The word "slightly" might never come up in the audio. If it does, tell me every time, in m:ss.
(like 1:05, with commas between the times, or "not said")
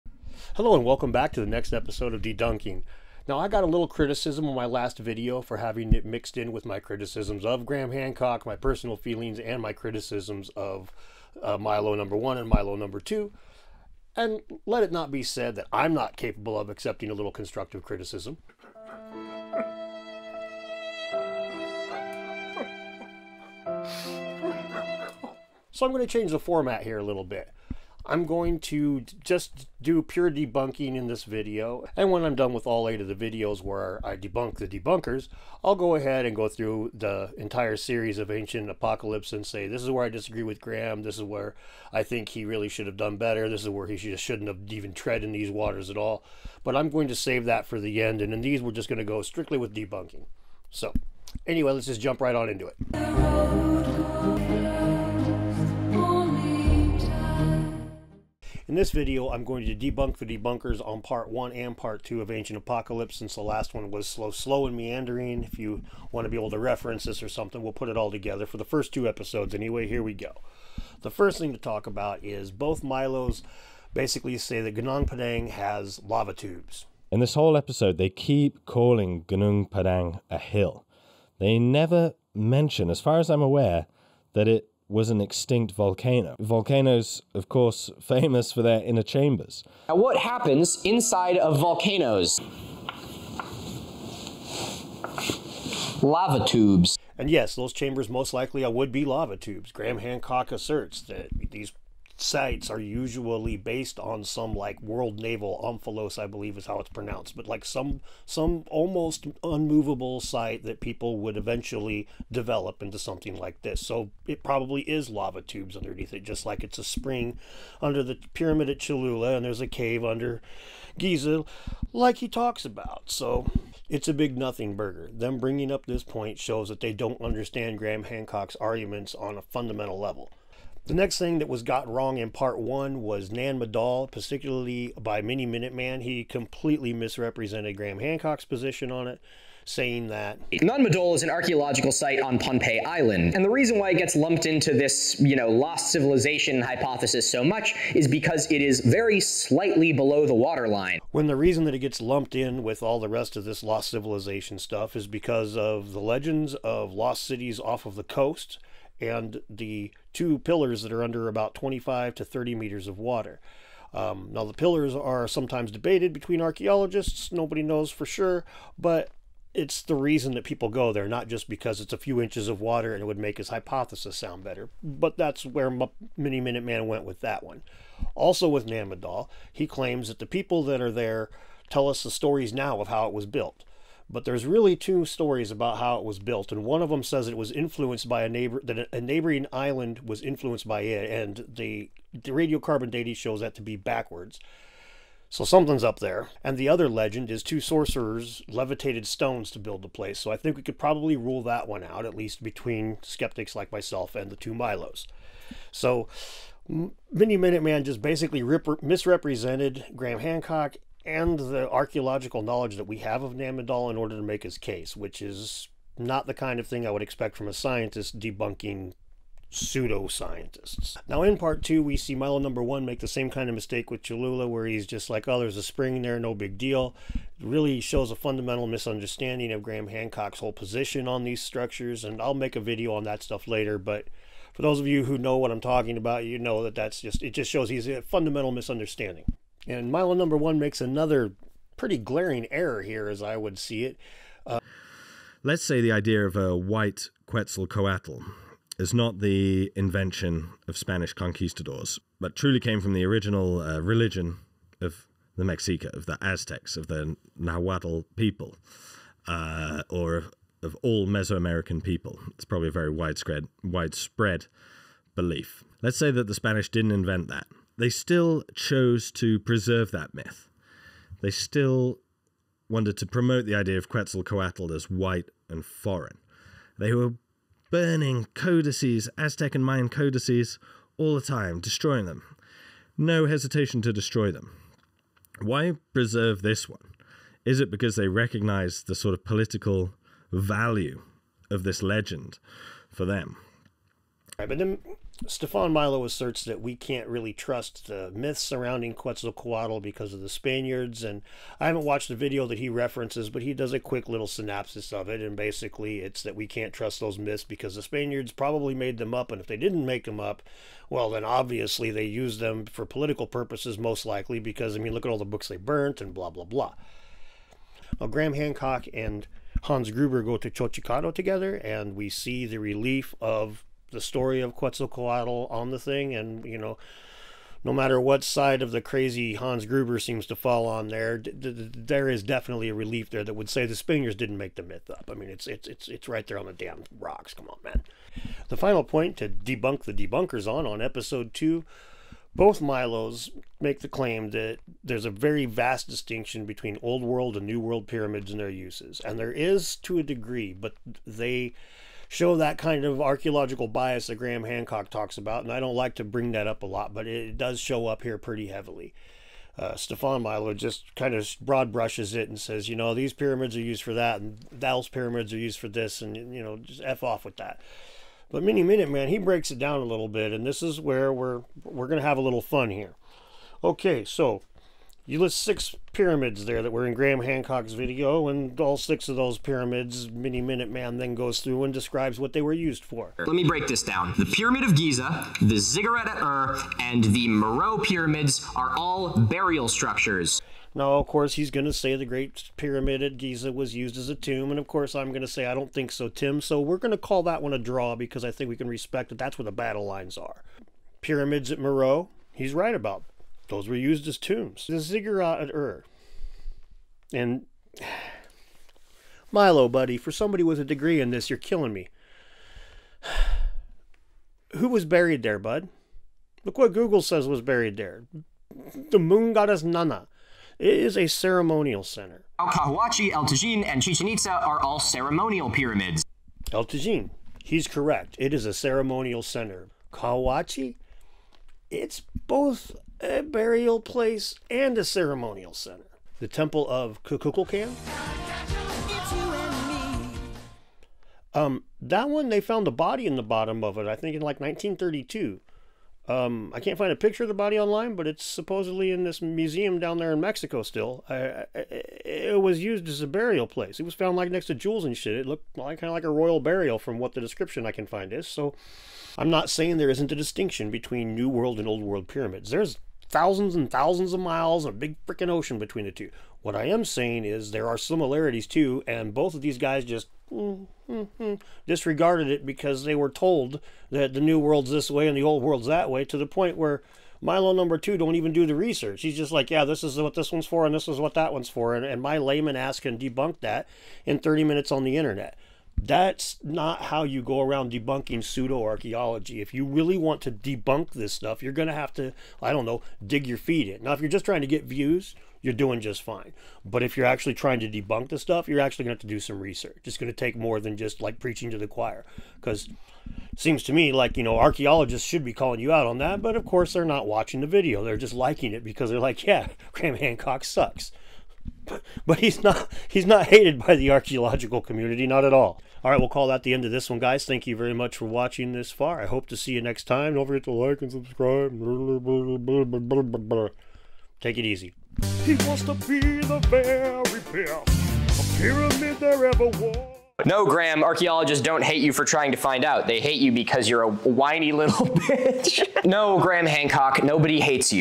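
2:29.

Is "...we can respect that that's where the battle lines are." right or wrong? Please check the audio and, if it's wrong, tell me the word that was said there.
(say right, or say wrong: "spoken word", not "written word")
right.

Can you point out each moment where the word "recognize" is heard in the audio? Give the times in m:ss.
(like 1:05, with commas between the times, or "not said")
4:48.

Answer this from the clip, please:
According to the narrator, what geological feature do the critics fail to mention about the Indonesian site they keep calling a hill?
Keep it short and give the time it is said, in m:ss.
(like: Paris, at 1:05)
extinct volcano, at 1:25.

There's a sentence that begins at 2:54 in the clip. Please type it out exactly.
But that's where Mini Minuteman went with that one.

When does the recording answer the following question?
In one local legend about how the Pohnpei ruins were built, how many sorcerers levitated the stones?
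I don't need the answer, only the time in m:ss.
3:17.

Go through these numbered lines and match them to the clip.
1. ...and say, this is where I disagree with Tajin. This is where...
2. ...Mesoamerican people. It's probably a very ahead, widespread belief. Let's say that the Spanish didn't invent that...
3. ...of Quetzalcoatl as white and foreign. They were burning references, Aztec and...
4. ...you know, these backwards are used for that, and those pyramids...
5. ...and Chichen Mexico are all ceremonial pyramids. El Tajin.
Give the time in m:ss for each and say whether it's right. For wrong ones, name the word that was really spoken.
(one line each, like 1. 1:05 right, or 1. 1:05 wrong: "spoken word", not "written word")
1. 0:39 wrong: "Graham", not "Tajin"
2. 4:21 wrong: "widespread", not "ahead"
3. 4:33 wrong: "codices", not "references"
4. 6:02 wrong: "pyramids", not "backwards"
5. 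7:03 wrong: "Itza", not "Mexico".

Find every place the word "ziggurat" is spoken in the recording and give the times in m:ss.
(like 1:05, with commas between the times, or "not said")
6:25, 6:44.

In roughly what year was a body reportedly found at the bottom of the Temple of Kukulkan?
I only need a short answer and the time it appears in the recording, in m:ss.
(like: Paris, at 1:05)
1932, at 7:24.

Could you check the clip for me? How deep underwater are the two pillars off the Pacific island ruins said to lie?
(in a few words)
25 to 30 meters.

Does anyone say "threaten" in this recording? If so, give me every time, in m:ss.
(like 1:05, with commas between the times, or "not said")
not said.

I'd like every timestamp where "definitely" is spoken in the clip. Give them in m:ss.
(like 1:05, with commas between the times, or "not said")
5:32.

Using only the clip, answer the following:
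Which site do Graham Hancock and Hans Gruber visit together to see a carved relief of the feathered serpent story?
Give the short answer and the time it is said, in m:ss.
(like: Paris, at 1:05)
Xochicalco, at 5:20.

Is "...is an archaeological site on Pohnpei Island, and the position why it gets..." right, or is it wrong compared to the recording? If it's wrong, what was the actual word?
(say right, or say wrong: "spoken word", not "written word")
wrong: "reason", not "position".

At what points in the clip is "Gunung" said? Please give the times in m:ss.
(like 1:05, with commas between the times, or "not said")
1:14, 1:19.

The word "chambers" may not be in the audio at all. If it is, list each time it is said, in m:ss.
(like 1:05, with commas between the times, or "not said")
1:29, 1:37.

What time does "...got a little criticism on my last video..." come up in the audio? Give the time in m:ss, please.
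0:03.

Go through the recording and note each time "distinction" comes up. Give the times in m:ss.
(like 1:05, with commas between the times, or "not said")
5:45, 7:40.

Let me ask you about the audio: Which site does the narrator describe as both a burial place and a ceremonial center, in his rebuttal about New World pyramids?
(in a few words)
Cahuachi.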